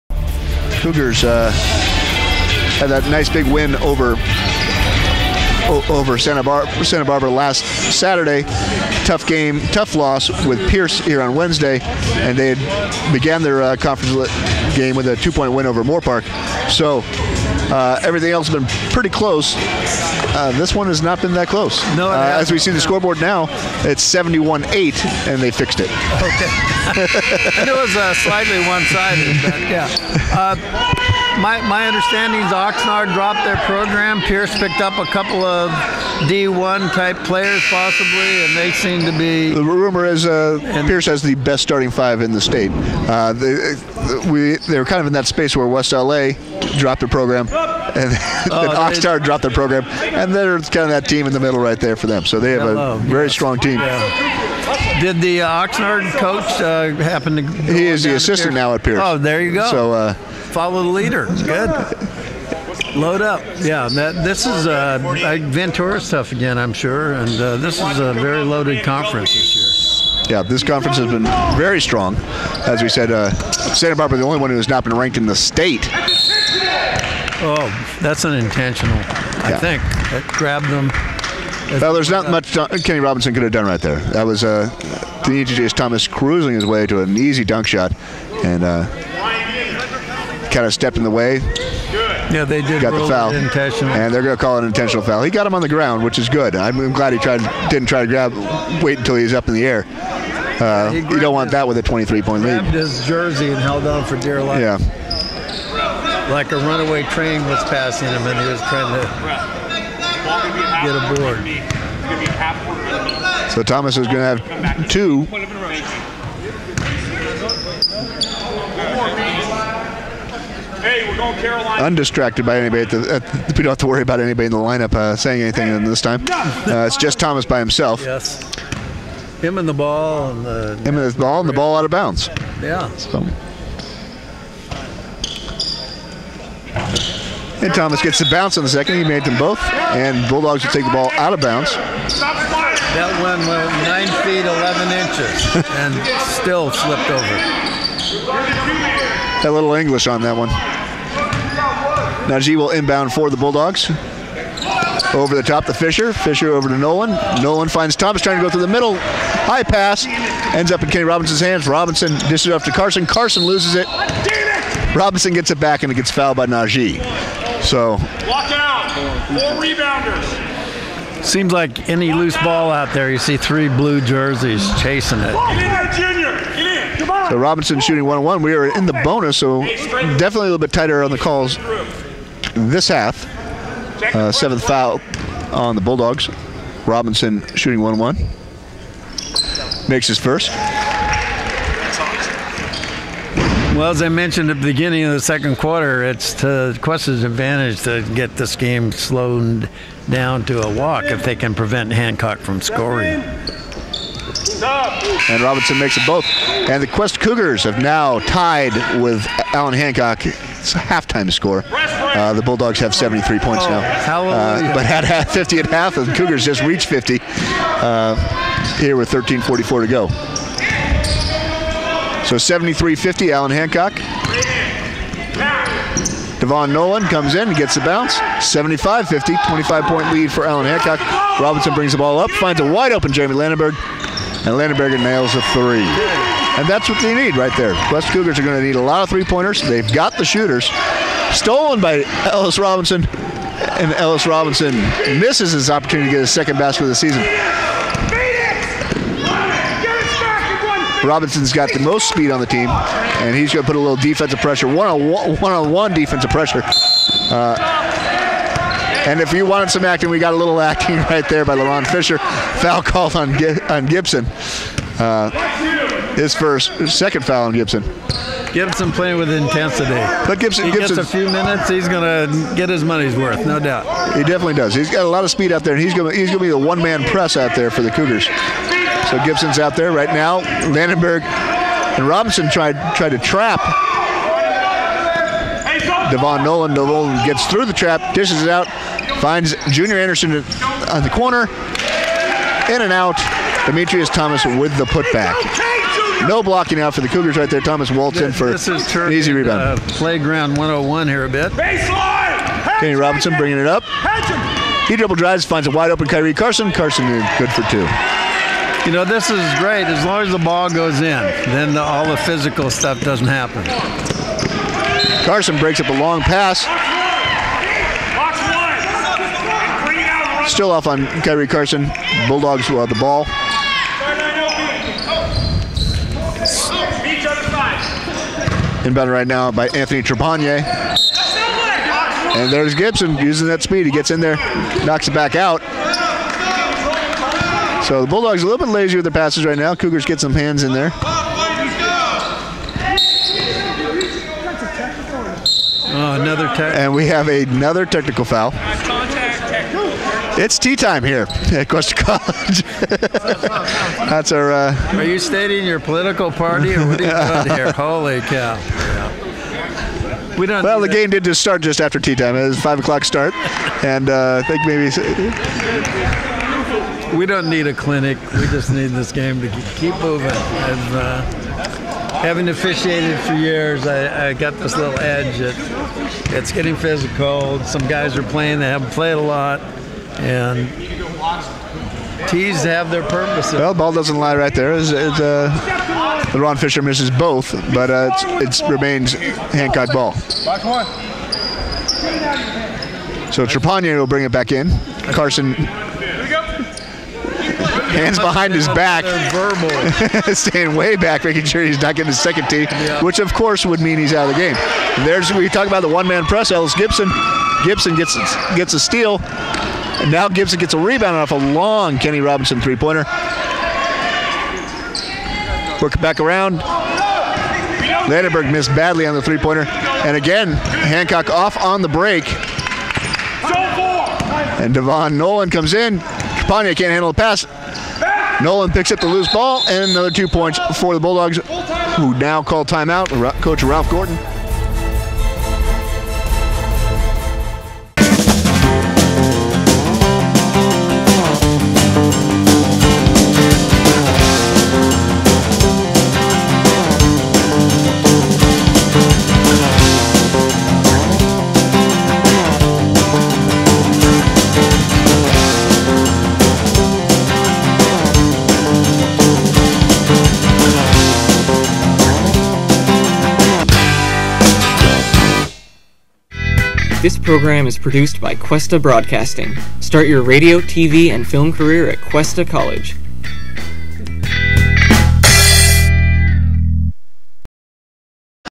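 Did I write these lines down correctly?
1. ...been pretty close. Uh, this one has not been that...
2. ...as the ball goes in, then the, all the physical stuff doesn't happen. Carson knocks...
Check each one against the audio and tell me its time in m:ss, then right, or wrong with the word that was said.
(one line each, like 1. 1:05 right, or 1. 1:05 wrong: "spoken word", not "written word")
1. 0:18 right
2. 5:10 wrong: "breaks", not "knocks".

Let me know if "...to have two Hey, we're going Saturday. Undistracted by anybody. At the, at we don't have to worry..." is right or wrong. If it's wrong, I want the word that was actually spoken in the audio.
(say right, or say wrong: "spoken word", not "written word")
wrong: "Carolina", not "Saturday".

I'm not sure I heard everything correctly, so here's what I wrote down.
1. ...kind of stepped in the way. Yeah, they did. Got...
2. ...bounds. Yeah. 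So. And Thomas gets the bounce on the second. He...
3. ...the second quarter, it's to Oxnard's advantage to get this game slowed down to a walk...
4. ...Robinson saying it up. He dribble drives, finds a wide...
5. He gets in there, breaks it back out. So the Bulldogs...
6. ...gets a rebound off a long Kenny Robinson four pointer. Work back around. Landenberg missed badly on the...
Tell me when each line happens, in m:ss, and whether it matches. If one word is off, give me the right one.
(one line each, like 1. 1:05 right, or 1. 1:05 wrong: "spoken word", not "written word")
1. 1:30 right
2. 2:11 right
3. 3:15 wrong: "Cuesta", not "Oxnard"
4. 5:02 wrong: "bringing", not "saying"
5. 5:33 wrong: "knocks", not "breaks"
6. 6:50 wrong: "three", not "four".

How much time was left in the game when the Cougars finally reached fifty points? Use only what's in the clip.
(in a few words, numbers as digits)
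13:44.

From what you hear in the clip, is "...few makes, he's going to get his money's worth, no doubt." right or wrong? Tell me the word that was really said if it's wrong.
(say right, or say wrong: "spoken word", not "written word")
wrong: "minutes", not "makes".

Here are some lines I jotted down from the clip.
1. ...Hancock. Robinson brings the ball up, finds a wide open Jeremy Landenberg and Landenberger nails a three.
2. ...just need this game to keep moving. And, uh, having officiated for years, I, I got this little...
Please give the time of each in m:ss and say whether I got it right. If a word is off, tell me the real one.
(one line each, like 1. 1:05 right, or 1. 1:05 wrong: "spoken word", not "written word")
1. 3:50 right
2. 6:08 right.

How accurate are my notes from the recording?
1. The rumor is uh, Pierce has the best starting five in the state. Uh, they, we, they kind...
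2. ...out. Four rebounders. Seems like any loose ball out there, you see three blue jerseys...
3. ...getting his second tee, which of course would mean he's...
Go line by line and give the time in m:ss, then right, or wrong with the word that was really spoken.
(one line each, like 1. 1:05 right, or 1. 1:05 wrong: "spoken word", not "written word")
1. 0:39 right
2. 2:48 right
3. 6:41 right.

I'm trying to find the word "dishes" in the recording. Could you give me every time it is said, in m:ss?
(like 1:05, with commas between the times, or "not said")
2:42, 4:48.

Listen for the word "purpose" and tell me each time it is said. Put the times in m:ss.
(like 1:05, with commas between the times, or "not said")
6:23.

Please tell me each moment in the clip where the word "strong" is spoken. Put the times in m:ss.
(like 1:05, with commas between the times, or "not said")
0:53, 1:11.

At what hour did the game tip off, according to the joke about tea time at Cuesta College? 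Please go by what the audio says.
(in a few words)
5 o'clock.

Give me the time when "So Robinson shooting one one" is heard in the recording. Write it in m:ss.
2:57.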